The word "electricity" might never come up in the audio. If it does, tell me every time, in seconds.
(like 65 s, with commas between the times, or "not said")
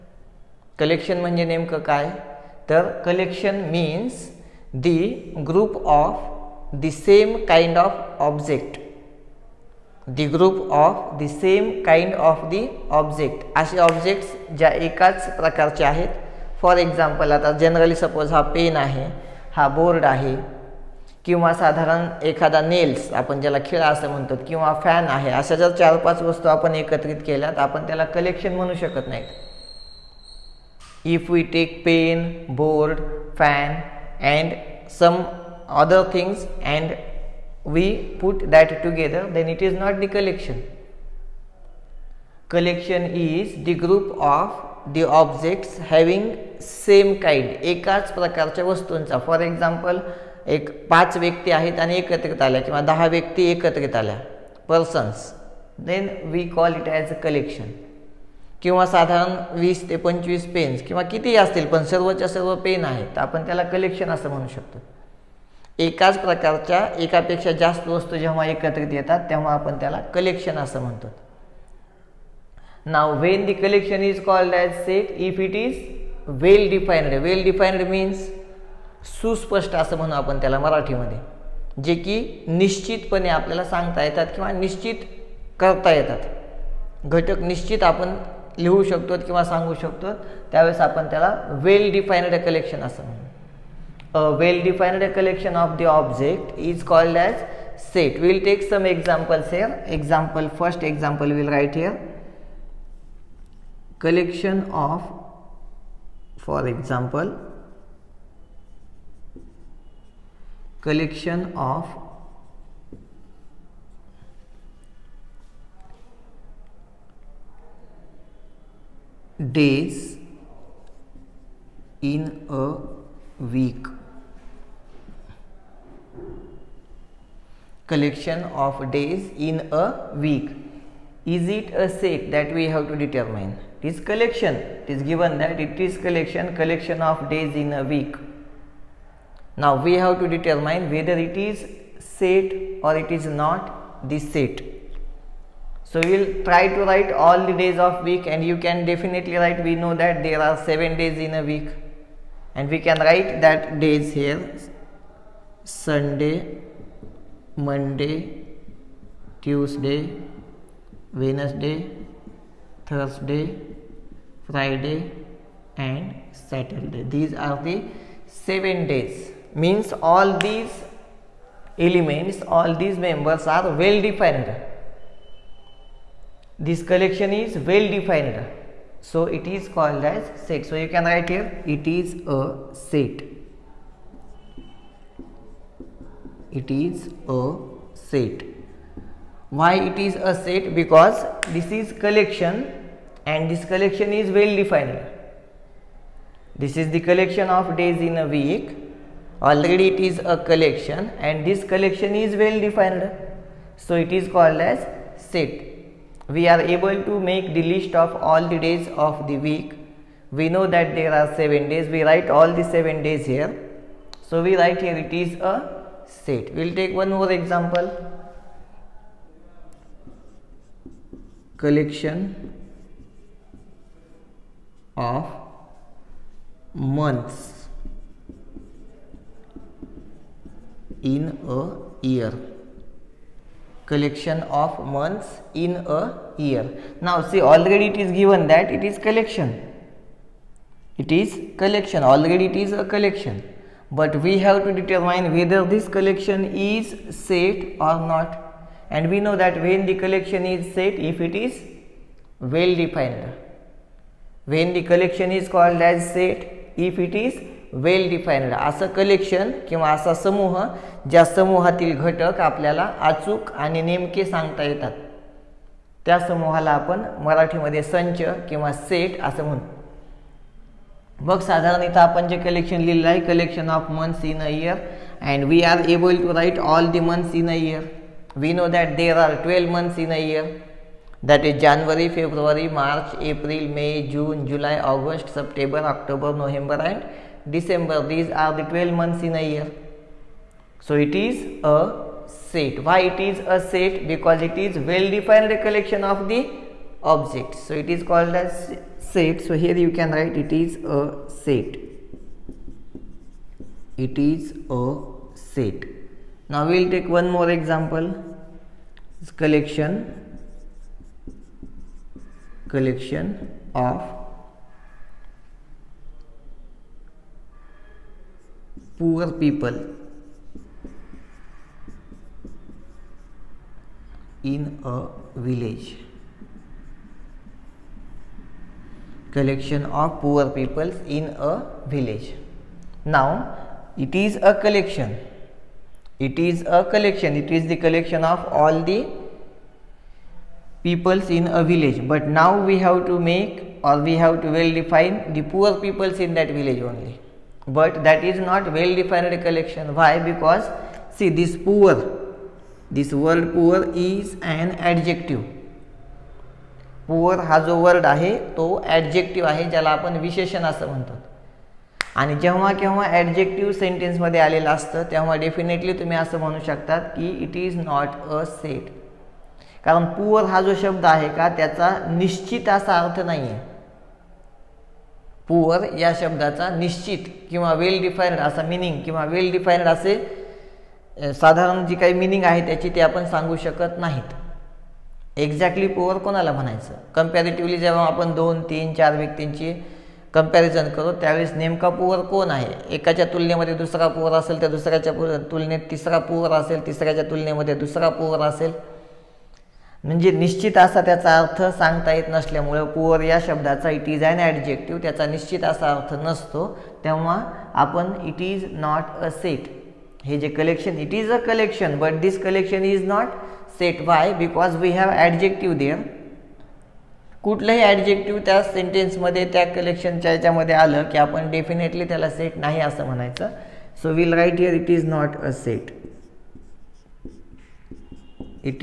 not said.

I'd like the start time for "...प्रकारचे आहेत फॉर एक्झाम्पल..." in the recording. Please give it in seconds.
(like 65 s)
15 s.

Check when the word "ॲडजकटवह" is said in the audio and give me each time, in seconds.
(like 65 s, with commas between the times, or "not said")
358 s, 363 s, 404 s, 417 s.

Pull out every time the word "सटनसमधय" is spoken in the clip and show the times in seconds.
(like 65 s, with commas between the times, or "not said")
363 s, 418 s.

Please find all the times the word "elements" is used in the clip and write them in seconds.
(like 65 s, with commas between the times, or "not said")
171 s.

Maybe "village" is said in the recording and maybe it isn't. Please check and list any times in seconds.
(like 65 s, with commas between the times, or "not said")
325 s, 331 s, 341 s, 346 s.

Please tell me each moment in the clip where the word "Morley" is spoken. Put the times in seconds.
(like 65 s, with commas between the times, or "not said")
not said.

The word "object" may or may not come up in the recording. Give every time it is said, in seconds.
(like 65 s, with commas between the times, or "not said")
8 s, 45 s, 95 s, 297 s.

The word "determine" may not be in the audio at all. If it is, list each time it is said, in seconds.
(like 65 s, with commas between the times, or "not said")
132 s, 140 s.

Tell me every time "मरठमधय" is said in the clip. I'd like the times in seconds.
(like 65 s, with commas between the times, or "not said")
80 s, 267 s.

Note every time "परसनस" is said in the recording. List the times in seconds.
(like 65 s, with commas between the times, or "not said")
54 s.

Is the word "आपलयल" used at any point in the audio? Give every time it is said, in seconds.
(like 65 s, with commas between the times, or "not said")
83 s, 262 s.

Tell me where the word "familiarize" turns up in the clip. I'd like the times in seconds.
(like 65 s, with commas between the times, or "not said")
not said.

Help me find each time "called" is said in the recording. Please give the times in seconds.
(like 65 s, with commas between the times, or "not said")
96 s, 179 s, 204 s, 255 s, 298 s.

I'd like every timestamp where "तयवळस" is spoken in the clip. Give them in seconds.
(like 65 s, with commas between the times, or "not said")
90 s, 391 s.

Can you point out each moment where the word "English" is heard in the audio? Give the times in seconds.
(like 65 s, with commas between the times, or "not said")
not said.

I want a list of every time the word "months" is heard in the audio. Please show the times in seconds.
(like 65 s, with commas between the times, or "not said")
226 s, 234 s.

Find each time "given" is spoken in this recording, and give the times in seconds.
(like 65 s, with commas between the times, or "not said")
135 s, 238 s.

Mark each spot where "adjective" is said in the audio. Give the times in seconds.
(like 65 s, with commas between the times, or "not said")
354 s, 415 s.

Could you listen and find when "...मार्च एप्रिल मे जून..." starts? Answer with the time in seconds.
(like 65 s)
282 s.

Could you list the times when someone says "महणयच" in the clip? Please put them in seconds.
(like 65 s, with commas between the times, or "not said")
386 s, 423 s.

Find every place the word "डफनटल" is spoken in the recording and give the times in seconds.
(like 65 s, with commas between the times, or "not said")
365 s, 421 s.